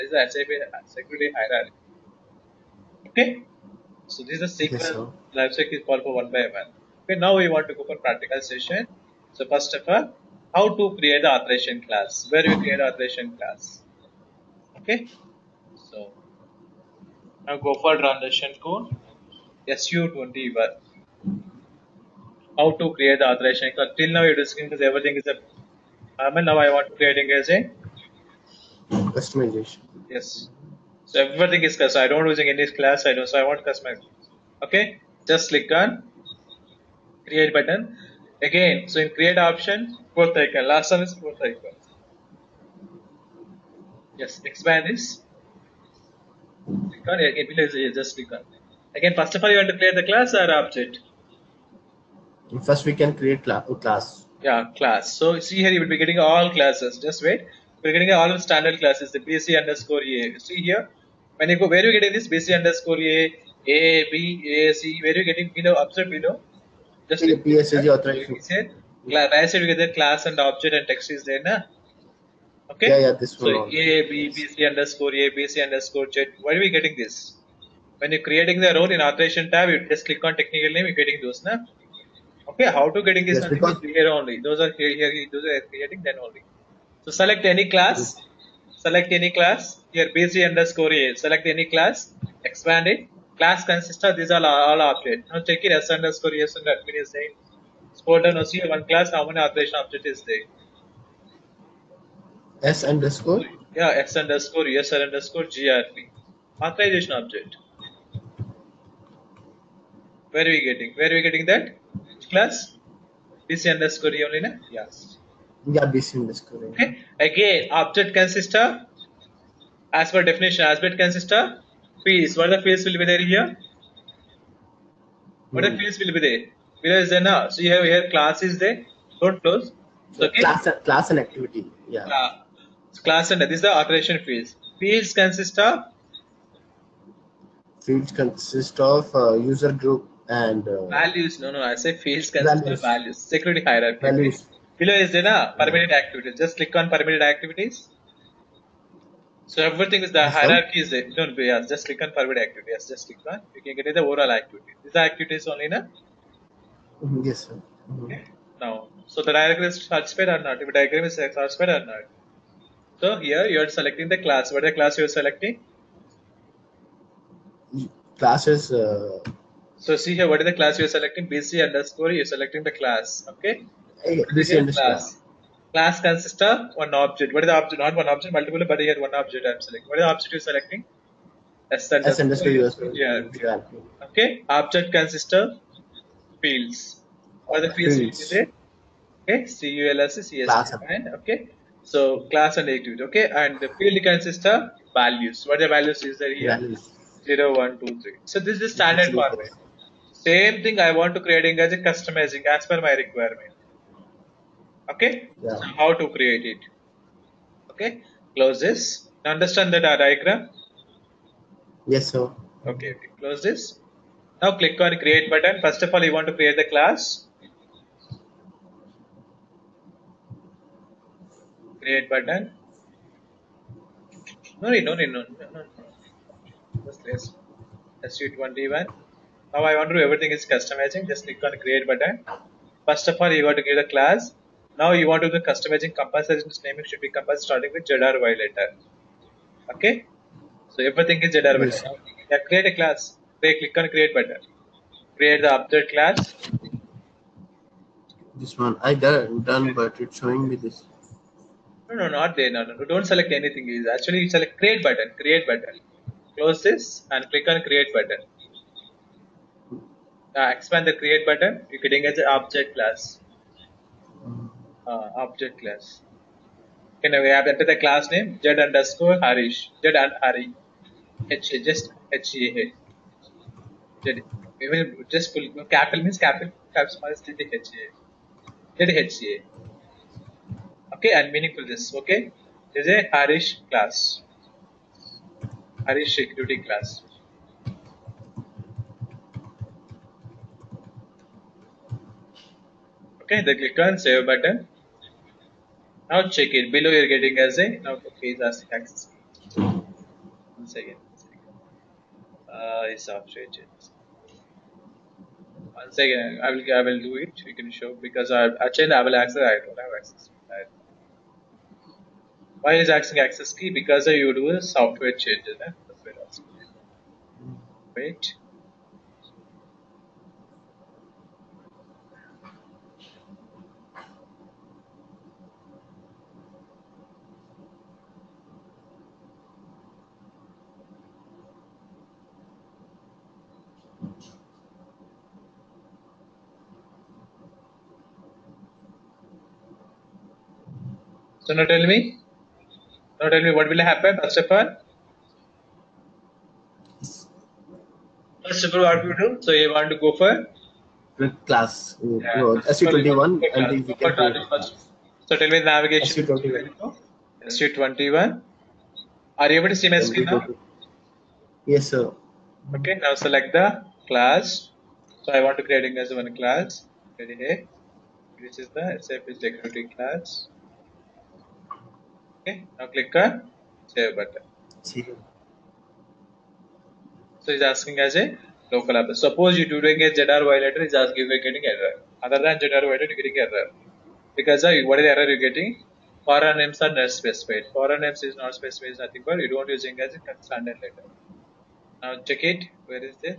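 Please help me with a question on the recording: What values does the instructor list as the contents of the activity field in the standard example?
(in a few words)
0, 1, 2, 3.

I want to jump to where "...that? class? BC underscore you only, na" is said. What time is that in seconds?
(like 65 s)
111 s.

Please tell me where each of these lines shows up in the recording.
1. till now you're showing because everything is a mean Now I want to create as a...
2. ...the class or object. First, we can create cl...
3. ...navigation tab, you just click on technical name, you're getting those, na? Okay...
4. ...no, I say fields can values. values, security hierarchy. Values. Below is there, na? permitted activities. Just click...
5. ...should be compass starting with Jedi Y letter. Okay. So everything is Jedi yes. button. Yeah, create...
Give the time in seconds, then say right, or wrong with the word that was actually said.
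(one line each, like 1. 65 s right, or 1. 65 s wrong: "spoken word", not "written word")
1. 23 s wrong: "discussing", not "showing"
2. 49 s right
3. 78 s wrong: "authorization", not "navigation"
4. 141 s right
5. 236 s right.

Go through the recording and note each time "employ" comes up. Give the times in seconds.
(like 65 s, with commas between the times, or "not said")
not said.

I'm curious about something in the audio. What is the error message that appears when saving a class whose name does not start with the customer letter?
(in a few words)
Foreign names are not specified.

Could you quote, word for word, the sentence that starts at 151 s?
No, yes, just click on permitted activities.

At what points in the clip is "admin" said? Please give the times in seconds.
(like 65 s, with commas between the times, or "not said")
96 s.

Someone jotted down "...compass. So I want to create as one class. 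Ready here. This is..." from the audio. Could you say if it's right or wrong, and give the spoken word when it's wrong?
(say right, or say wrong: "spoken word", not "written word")
wrong: "class", not "compass".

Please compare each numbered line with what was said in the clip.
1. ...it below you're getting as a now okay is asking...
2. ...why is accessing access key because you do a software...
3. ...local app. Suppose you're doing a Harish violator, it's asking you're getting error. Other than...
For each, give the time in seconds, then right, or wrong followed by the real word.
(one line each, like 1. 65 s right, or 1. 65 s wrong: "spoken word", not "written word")
1. 296 s right
2. 312 s right
3. 378 s wrong: "JDR", not "Harish".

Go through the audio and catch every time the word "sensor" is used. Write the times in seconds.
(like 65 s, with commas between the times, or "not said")
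not said.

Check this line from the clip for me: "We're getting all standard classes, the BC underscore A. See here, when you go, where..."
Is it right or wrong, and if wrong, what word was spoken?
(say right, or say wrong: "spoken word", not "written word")
right.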